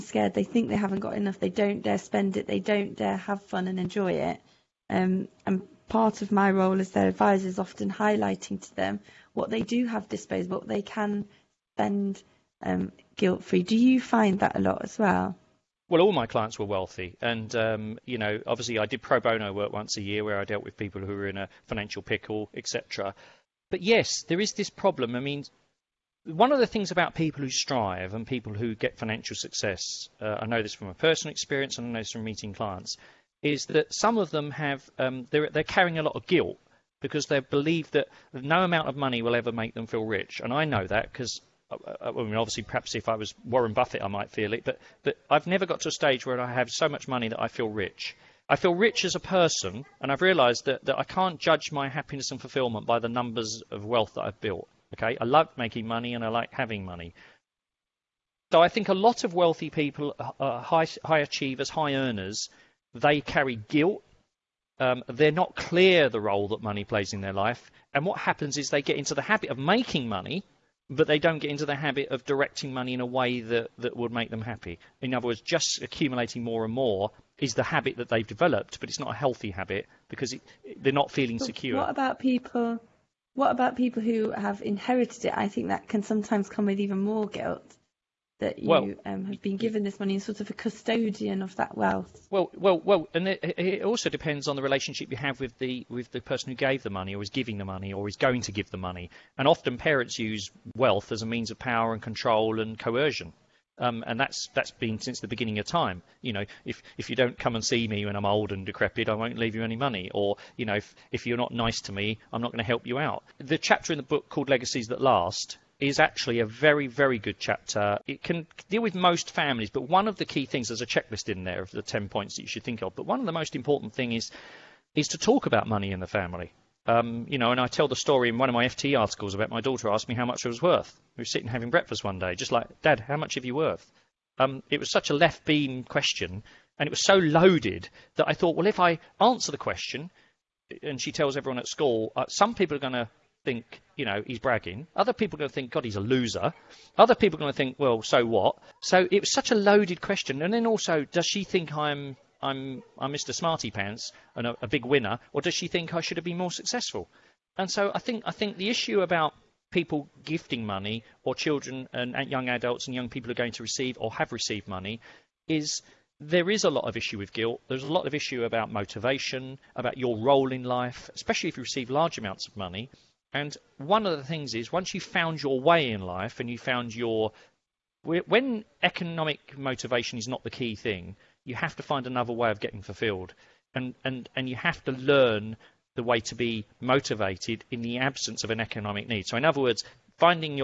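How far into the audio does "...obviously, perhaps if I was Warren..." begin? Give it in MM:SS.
00:42.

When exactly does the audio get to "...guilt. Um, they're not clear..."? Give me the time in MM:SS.
01:03.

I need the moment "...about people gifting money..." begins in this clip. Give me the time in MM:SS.
02:39.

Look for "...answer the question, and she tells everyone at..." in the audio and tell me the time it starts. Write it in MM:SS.
02:19.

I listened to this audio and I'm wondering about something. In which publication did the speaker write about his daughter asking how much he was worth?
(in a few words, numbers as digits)
FT.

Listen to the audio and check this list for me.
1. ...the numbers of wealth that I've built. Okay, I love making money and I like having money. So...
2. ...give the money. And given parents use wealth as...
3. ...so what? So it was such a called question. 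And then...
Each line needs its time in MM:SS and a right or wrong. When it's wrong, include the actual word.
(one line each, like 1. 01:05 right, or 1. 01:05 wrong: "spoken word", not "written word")
1. 00:52 right
2. 01:38 wrong: "often", not "given"
3. 02:28 wrong: "loaded", not "called".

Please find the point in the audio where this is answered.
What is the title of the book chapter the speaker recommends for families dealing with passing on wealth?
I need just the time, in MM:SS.
01:54.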